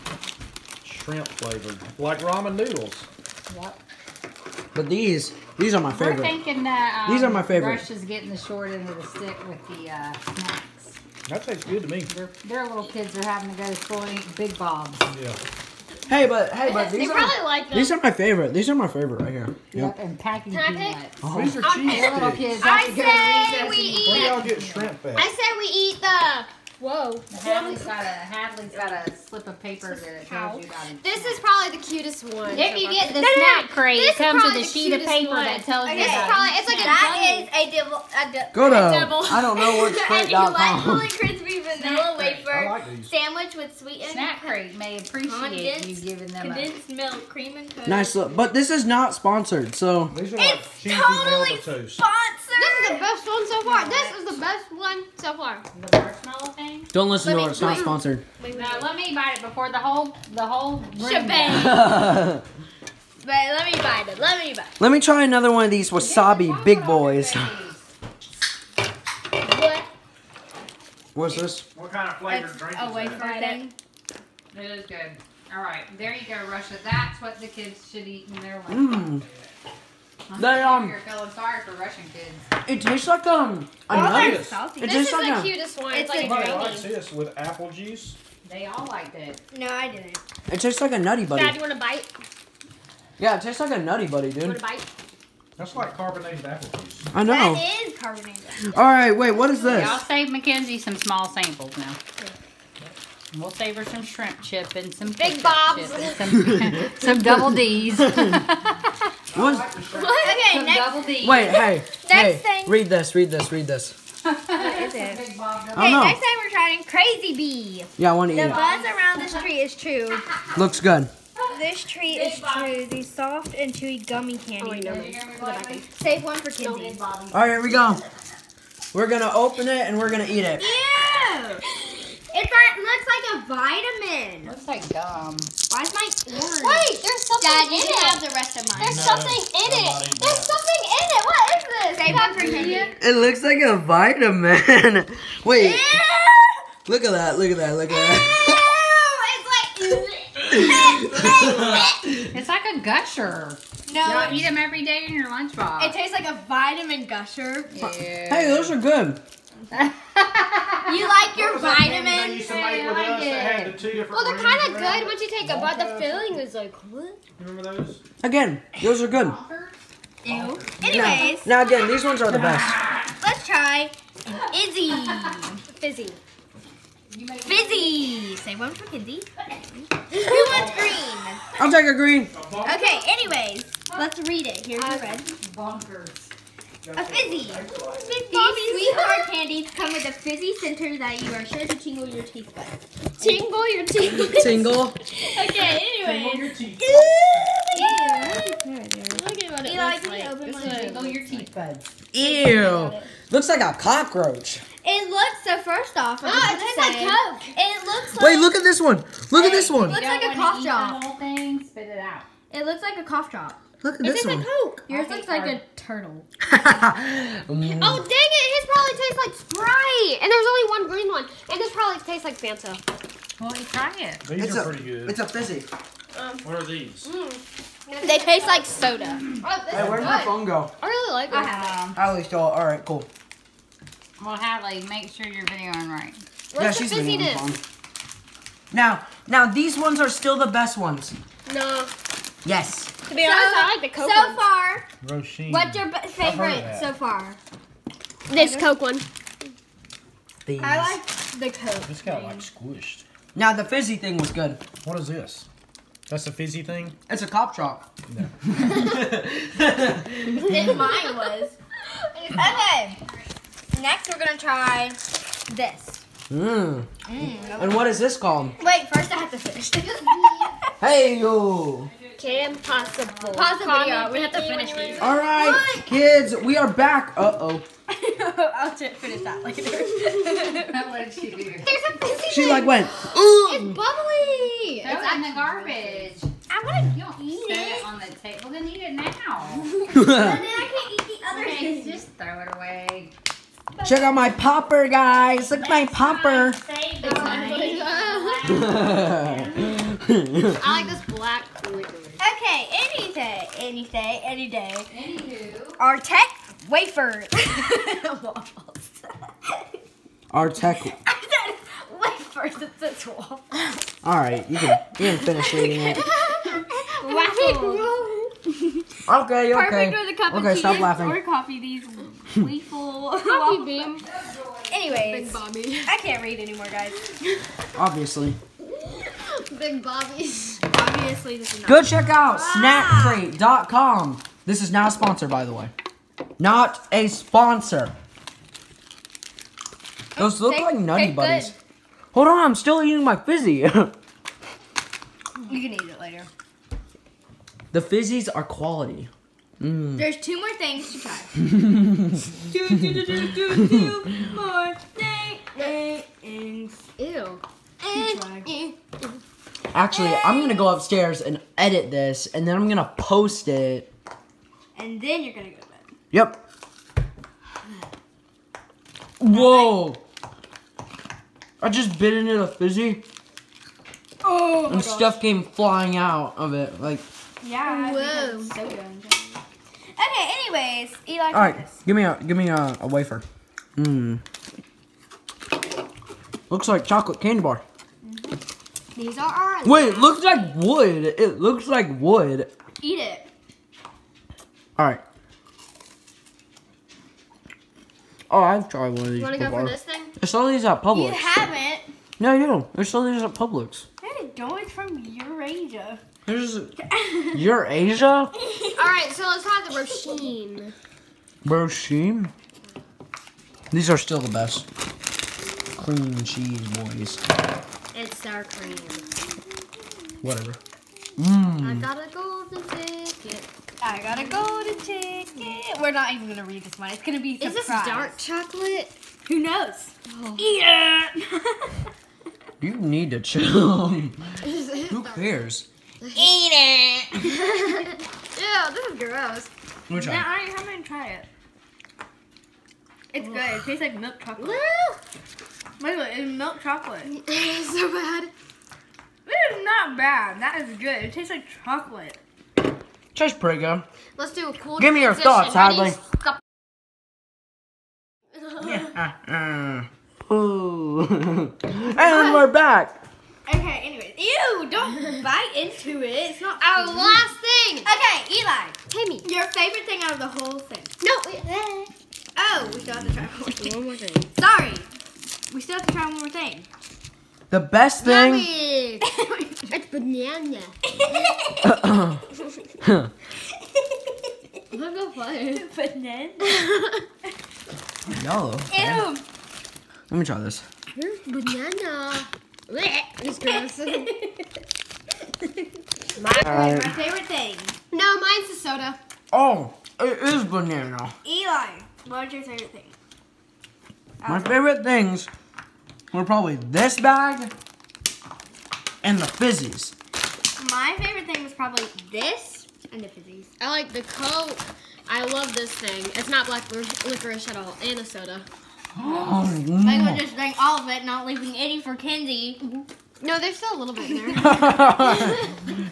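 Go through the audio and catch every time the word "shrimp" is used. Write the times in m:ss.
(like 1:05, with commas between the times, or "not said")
0:00, 0:24, 1:44.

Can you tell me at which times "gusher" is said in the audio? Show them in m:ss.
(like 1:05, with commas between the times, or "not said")
2:32, 2:37.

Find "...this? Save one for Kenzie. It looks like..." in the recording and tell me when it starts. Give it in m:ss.
2:21.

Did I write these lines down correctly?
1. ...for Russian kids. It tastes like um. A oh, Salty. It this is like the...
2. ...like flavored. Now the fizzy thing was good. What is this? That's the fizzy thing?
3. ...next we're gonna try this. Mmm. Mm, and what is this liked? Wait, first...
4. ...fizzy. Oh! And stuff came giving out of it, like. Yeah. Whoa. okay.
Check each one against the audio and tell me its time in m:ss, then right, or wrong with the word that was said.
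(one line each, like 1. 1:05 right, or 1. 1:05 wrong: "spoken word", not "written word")
1. 1:21 right
2. 4:12 wrong: "squished", not "flavored"
3. 4:23 wrong: "called", not "liked"
4. 6:12 wrong: "flying", not "giving".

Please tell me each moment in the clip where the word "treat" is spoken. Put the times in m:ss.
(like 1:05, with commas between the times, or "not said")
2:01.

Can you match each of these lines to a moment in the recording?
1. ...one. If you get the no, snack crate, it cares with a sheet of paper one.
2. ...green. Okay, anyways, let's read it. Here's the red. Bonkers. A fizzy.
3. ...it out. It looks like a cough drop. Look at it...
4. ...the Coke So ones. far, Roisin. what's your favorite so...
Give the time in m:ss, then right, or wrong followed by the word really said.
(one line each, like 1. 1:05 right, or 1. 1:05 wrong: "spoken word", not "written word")
1. 0:32 wrong: "comes", not "cares"
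2. 3:01 right
3. 3:31 right
4. 4:03 right.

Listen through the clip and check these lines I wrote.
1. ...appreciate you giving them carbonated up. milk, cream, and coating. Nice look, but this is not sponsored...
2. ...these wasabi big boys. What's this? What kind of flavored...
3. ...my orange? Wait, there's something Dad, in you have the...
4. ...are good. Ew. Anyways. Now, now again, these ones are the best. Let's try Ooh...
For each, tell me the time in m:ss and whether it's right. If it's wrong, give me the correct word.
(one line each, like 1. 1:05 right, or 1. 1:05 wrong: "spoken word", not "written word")
1. 0:44 wrong: "condensed", not "carbonated"
2. 1:05 right
3. 2:15 right
4. 2:49 wrong: "Izzy", not "Ooh".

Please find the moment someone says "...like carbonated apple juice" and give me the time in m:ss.
1:35.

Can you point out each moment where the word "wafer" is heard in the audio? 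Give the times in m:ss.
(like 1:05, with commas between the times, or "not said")
0:42, 5:06, 5:12, 6:22.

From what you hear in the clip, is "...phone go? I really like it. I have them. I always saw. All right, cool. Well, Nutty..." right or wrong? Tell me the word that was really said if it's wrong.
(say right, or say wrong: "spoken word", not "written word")
wrong: "Hadley", not "Nutty".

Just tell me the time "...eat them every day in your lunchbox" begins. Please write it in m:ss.
2:34.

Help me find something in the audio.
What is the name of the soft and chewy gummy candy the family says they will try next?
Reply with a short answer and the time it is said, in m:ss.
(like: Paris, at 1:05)
Crazy Bee, at 1:56.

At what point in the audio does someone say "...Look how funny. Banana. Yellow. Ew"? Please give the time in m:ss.
8:04.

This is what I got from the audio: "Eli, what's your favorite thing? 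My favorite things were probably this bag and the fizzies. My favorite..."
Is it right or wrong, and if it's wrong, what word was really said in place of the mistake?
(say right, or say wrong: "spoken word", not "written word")
right.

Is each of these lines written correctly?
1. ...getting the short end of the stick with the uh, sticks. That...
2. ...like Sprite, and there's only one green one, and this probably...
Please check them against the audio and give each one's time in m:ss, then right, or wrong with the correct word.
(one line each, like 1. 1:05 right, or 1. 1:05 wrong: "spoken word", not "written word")
1. 0:08 wrong: "snacks", not "sticks"
2. 3:39 right.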